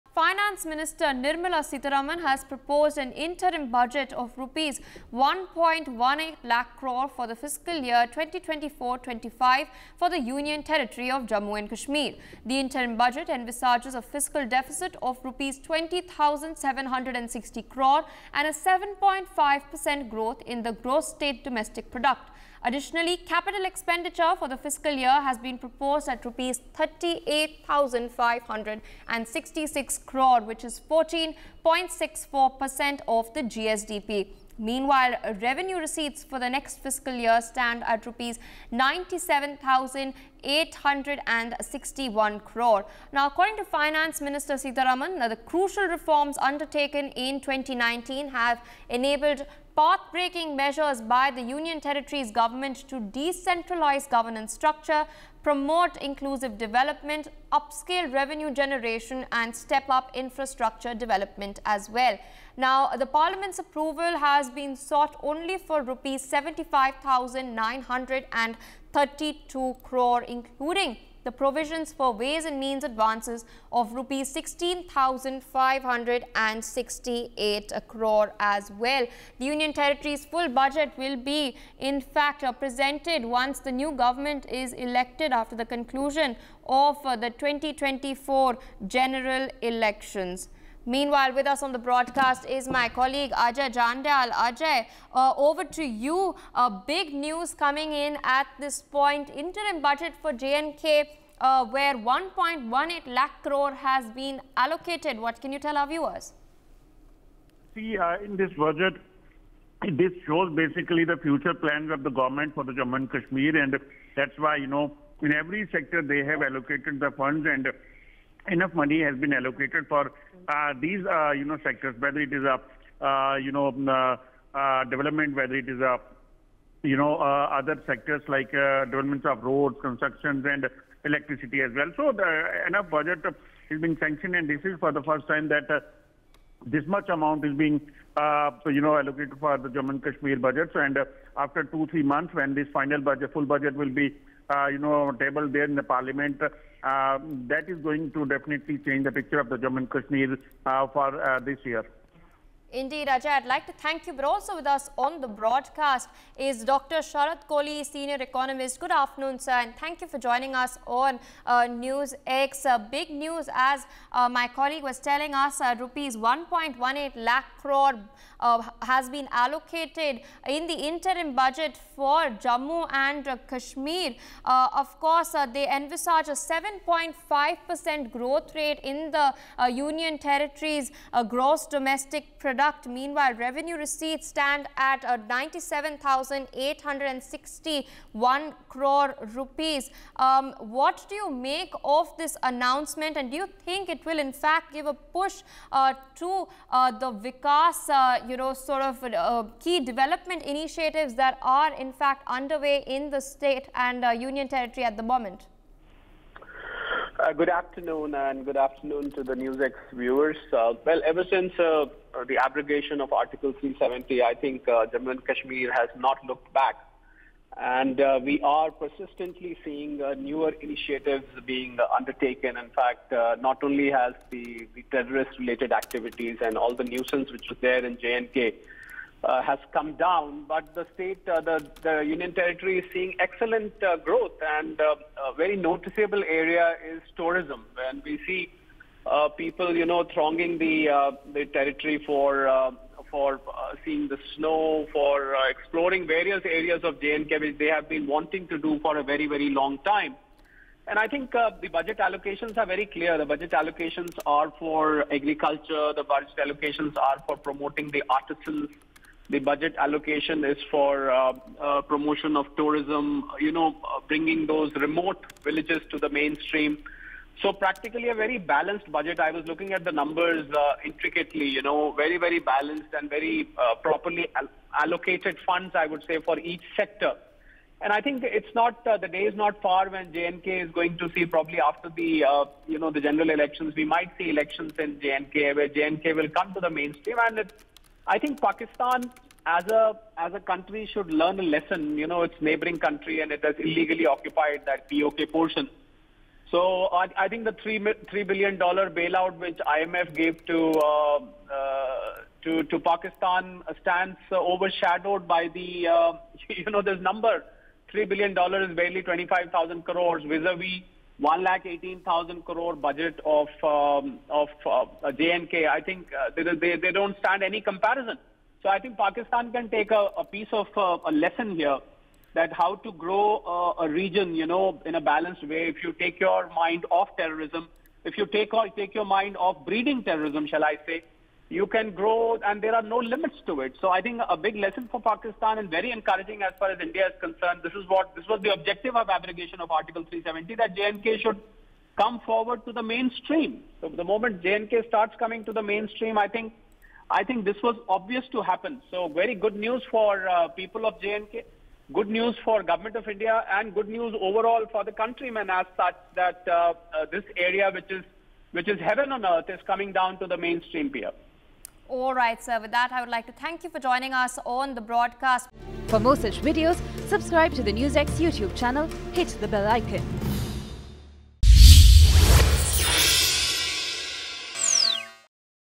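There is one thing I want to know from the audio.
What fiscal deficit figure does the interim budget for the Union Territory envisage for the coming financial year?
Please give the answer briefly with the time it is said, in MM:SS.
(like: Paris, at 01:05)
20,760 crore rupees, at 00:15.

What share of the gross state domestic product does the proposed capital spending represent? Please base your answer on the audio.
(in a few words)
14.64%.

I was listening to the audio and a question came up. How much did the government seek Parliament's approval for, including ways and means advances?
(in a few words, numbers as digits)
75,932 crore rupees.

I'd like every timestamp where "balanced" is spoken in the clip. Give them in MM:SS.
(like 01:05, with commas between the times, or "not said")
04:28, 04:32, 05:25.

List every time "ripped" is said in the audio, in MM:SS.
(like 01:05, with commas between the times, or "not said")
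not said.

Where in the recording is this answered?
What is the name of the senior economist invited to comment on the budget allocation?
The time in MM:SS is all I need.
02:37.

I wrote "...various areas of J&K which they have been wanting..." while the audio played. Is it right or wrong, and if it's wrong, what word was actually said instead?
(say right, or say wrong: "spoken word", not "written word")
right.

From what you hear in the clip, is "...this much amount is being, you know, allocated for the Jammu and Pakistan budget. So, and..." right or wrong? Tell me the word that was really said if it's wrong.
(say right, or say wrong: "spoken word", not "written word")
wrong: "Kashmir", not "Pakistan".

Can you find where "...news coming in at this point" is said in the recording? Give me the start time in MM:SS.
01:37.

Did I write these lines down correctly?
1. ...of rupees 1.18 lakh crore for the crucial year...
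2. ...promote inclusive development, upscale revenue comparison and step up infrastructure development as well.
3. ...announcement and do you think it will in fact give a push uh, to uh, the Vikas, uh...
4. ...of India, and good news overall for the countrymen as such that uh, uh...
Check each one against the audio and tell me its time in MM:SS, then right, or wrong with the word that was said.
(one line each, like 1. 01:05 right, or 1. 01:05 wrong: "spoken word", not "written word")
1. 00:04 wrong: "fiscal", not "crucial"
2. 00:55 wrong: "generation", not "comparison"
3. 03:12 right
4. 05:52 right.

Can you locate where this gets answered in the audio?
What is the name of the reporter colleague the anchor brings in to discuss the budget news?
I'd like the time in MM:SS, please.
01:33.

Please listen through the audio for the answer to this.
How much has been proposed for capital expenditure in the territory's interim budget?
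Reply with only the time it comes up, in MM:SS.
00:26.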